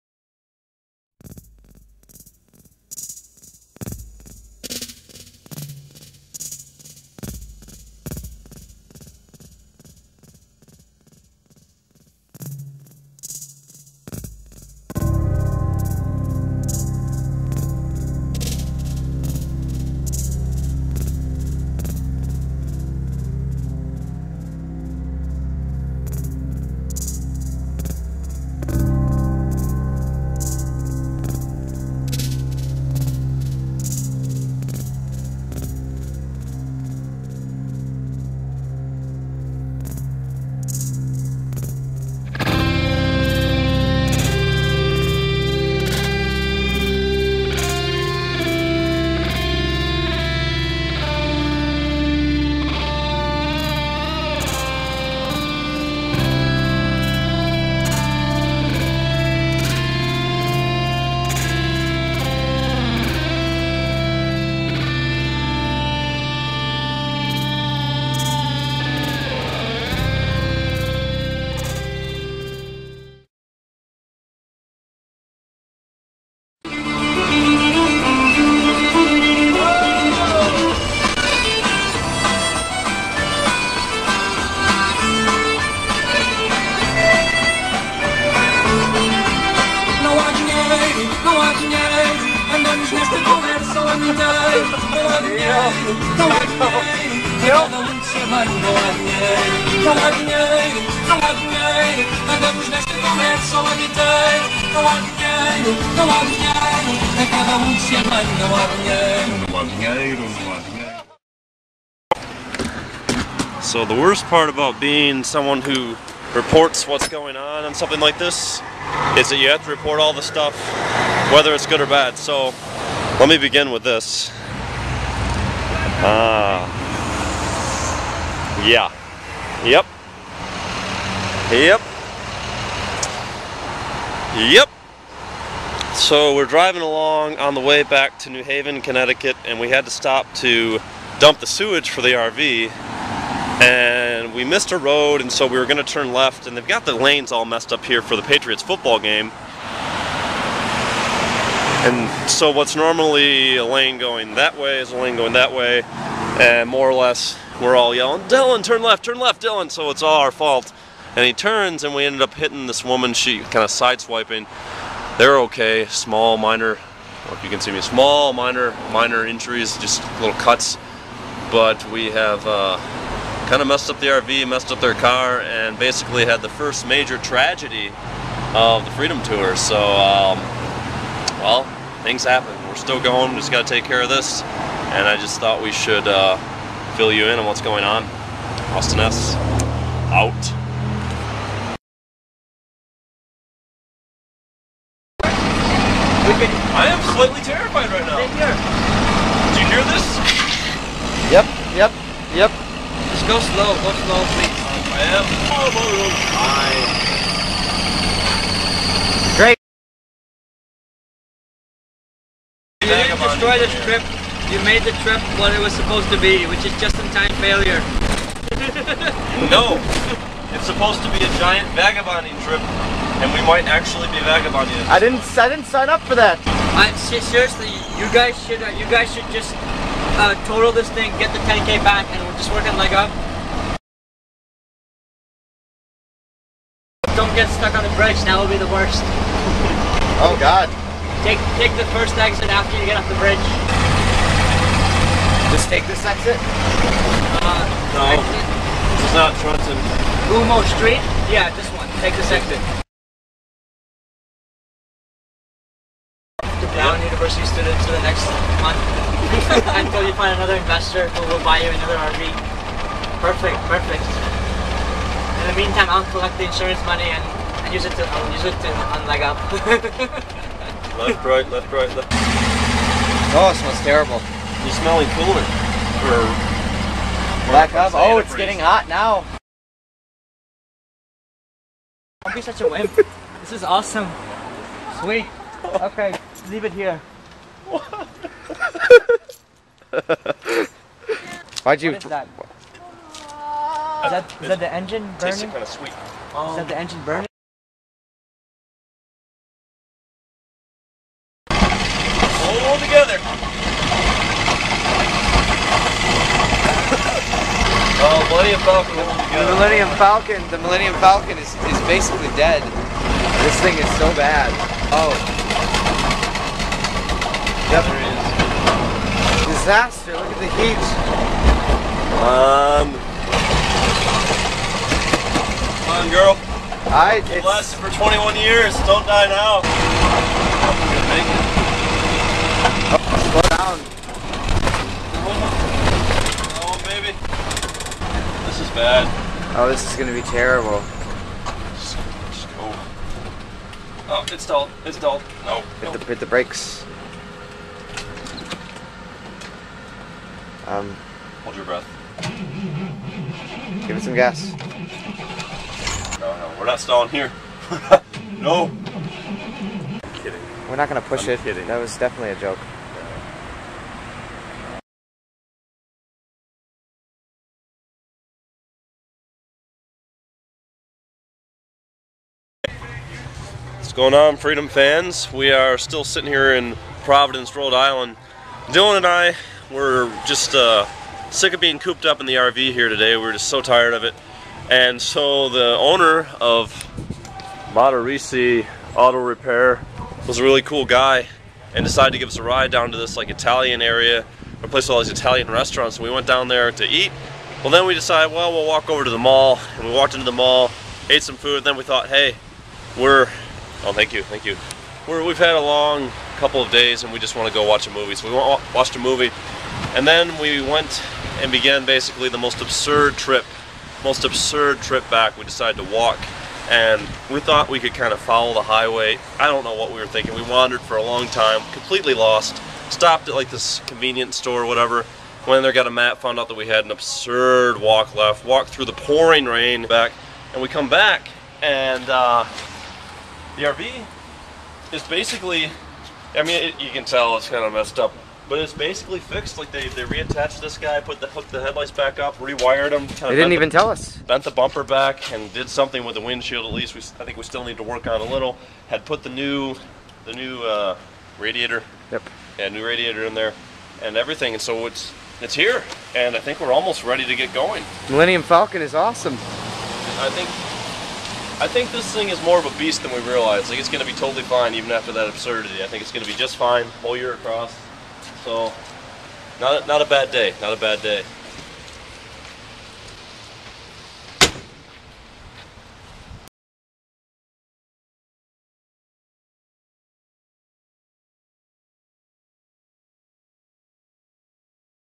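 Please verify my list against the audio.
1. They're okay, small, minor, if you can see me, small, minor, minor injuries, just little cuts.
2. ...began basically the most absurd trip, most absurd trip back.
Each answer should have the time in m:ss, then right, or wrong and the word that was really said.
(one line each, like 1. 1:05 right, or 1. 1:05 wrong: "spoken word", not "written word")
1. 2:45 right
2. 6:51 right.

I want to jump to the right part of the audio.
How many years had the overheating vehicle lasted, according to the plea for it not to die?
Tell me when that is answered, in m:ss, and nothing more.
5:27.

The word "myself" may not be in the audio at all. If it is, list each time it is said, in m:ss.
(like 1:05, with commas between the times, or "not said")
not said.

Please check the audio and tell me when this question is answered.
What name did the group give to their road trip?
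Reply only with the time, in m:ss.
2:58.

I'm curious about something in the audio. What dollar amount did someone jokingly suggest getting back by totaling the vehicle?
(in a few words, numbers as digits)
10K.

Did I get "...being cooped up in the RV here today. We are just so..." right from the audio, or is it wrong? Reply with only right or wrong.
right.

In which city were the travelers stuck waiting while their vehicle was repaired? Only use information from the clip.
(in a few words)
Providence.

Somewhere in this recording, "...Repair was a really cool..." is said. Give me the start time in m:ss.
6:29.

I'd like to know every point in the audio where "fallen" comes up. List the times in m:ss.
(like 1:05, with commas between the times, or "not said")
not said.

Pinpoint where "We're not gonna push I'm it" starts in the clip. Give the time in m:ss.
6:00.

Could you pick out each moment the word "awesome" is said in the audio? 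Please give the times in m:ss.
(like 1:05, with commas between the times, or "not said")
4:43, 7:38.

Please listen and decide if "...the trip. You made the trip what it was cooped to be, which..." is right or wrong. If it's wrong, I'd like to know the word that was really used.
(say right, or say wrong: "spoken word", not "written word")
wrong: "supposed", not "cooped".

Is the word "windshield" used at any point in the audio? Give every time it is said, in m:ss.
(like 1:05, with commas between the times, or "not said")
7:26.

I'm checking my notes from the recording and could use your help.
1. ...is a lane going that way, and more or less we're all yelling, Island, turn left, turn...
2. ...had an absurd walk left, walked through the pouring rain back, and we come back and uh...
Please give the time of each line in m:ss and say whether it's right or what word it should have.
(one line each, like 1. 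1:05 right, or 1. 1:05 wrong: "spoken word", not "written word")
1. 2:34 wrong: "Dillon", not "Island"
2. 7:06 right.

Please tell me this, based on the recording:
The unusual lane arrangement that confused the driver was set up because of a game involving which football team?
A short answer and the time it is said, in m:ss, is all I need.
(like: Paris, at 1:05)
Patriots, at 2:28.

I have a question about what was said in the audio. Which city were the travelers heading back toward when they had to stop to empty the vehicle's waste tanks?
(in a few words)
New Haven.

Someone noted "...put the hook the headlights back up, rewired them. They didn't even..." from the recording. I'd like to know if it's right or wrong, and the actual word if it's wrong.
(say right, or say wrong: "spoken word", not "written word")
right.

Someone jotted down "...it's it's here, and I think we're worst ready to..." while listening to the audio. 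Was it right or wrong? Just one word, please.
wrong.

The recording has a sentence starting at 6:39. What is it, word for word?
And we walked into the mall, ate some food.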